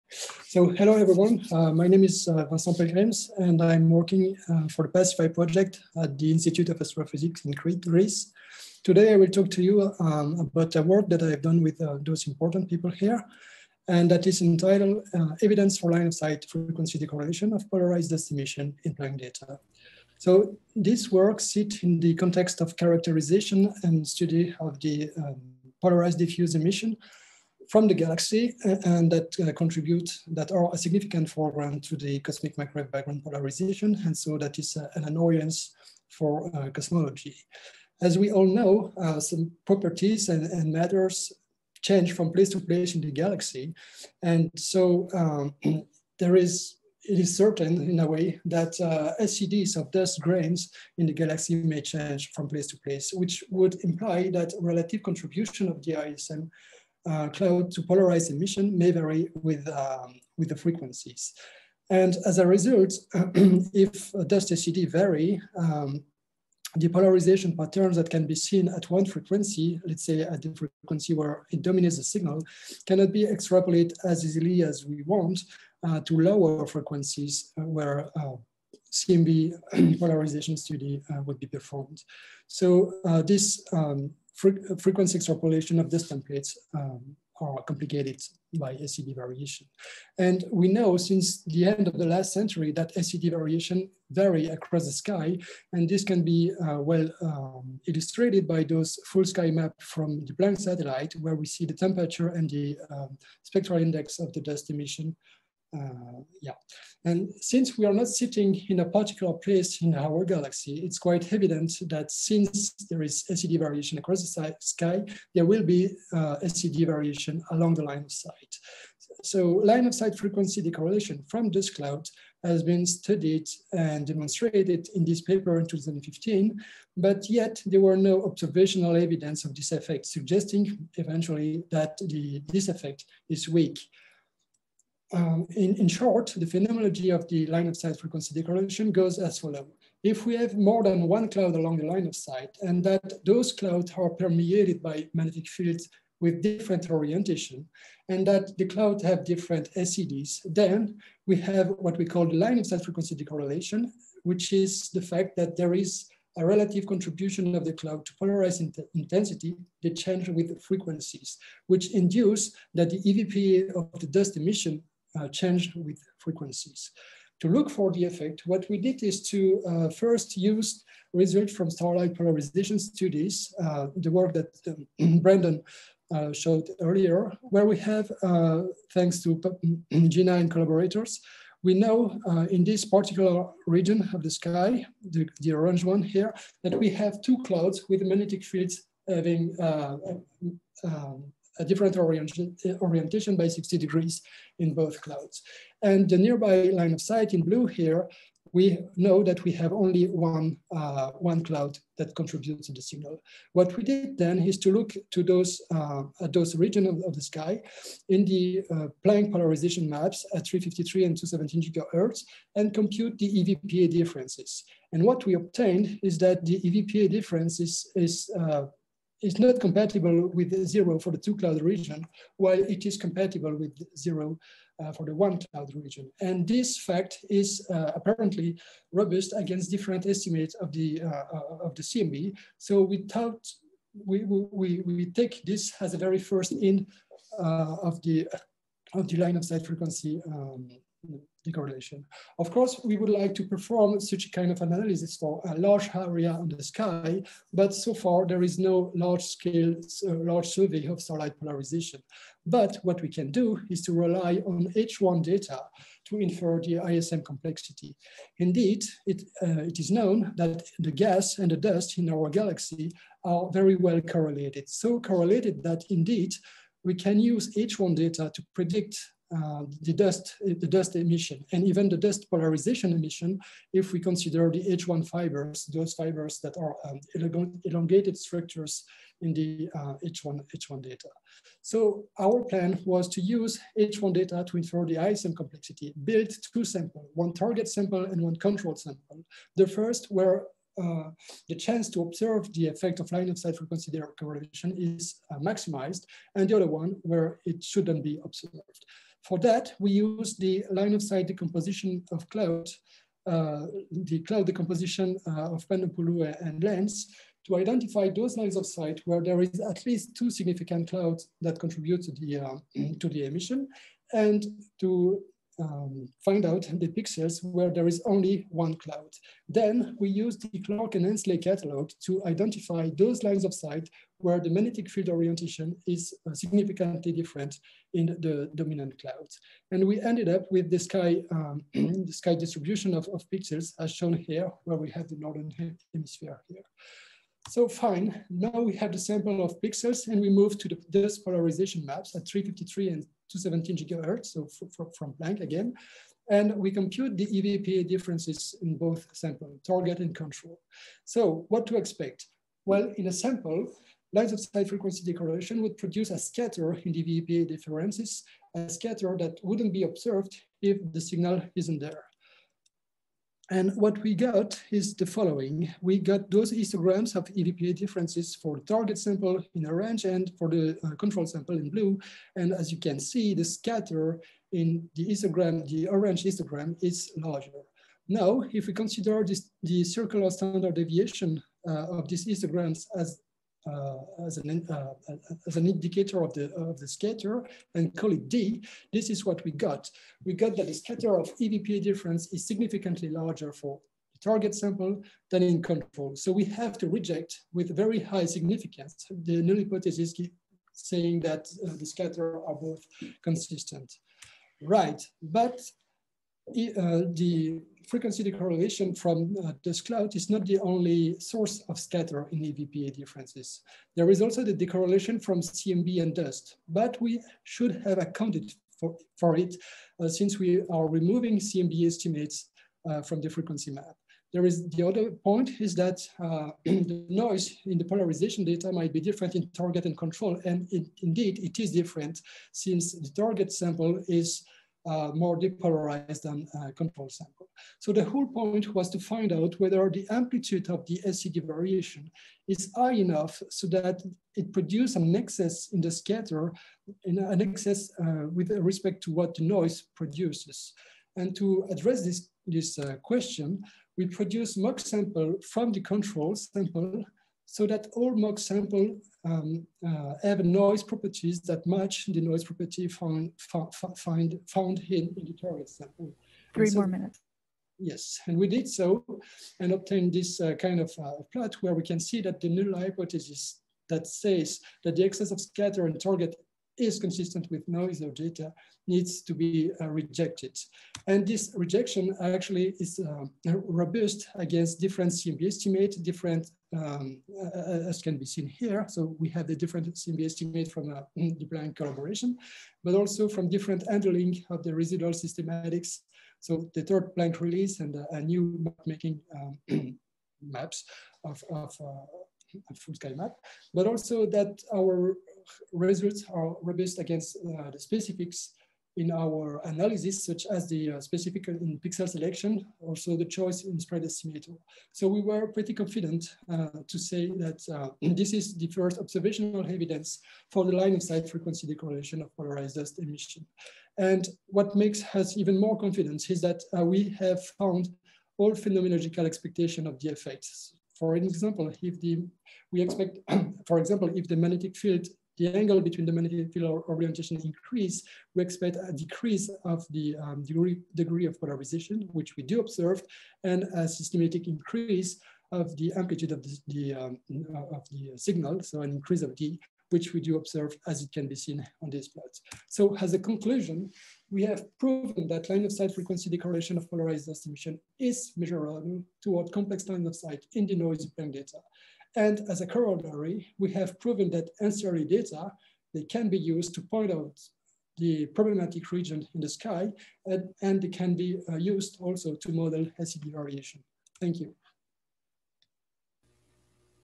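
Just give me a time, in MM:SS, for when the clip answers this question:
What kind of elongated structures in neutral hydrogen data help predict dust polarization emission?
04:34.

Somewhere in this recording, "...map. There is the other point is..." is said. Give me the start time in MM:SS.
07:03.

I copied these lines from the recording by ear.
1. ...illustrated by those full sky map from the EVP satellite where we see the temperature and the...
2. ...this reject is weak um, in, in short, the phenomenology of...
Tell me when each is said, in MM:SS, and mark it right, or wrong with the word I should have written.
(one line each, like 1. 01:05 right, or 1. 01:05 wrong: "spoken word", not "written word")
1. 01:37 wrong: "Planck", not "EVP"
2. 02:12 wrong: "effect", not "reject".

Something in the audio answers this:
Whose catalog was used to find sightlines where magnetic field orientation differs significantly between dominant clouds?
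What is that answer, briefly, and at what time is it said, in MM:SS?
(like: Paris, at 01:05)
Clark and Ensley, at 05:20.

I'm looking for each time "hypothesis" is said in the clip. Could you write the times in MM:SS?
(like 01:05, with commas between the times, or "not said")
06:39, 07:52.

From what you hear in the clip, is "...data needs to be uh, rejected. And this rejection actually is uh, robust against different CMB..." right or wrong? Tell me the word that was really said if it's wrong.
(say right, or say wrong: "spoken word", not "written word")
right.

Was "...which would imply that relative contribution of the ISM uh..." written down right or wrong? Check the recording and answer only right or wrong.
right.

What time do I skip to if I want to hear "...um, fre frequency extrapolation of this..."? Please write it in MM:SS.
01:23.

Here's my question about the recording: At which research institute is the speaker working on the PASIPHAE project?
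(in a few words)
Institute of Astrophysics in Crete.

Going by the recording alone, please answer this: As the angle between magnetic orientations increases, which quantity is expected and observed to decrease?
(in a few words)
degree of polarization.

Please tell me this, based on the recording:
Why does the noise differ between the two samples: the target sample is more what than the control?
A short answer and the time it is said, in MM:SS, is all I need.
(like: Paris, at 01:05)
depolarized, at 07:15.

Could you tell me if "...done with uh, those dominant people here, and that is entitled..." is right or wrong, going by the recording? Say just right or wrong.
wrong.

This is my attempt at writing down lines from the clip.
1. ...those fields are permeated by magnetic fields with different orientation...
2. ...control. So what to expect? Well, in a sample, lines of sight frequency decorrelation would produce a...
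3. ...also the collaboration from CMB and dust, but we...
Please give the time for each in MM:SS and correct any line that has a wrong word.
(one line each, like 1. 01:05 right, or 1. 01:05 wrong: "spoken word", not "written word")
1. 02:23 wrong: "clouds", not "fields"
2. 05:50 right
3. 06:54 wrong: "decorrelation", not "collaboration".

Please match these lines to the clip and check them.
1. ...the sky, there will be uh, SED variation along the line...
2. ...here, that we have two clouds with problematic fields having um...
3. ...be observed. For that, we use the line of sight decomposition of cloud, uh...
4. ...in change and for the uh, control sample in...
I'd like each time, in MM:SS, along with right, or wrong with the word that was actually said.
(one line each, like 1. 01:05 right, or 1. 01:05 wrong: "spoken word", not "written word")
1. 01:54 right
2. 03:06 wrong: "magnetic", not "problematic"
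3. 04:58 right
4. 06:09 wrong: "orange", not "change".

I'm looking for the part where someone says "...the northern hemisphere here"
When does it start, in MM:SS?
05:35.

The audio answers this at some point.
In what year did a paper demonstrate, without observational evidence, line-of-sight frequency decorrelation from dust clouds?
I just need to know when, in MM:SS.
02:05.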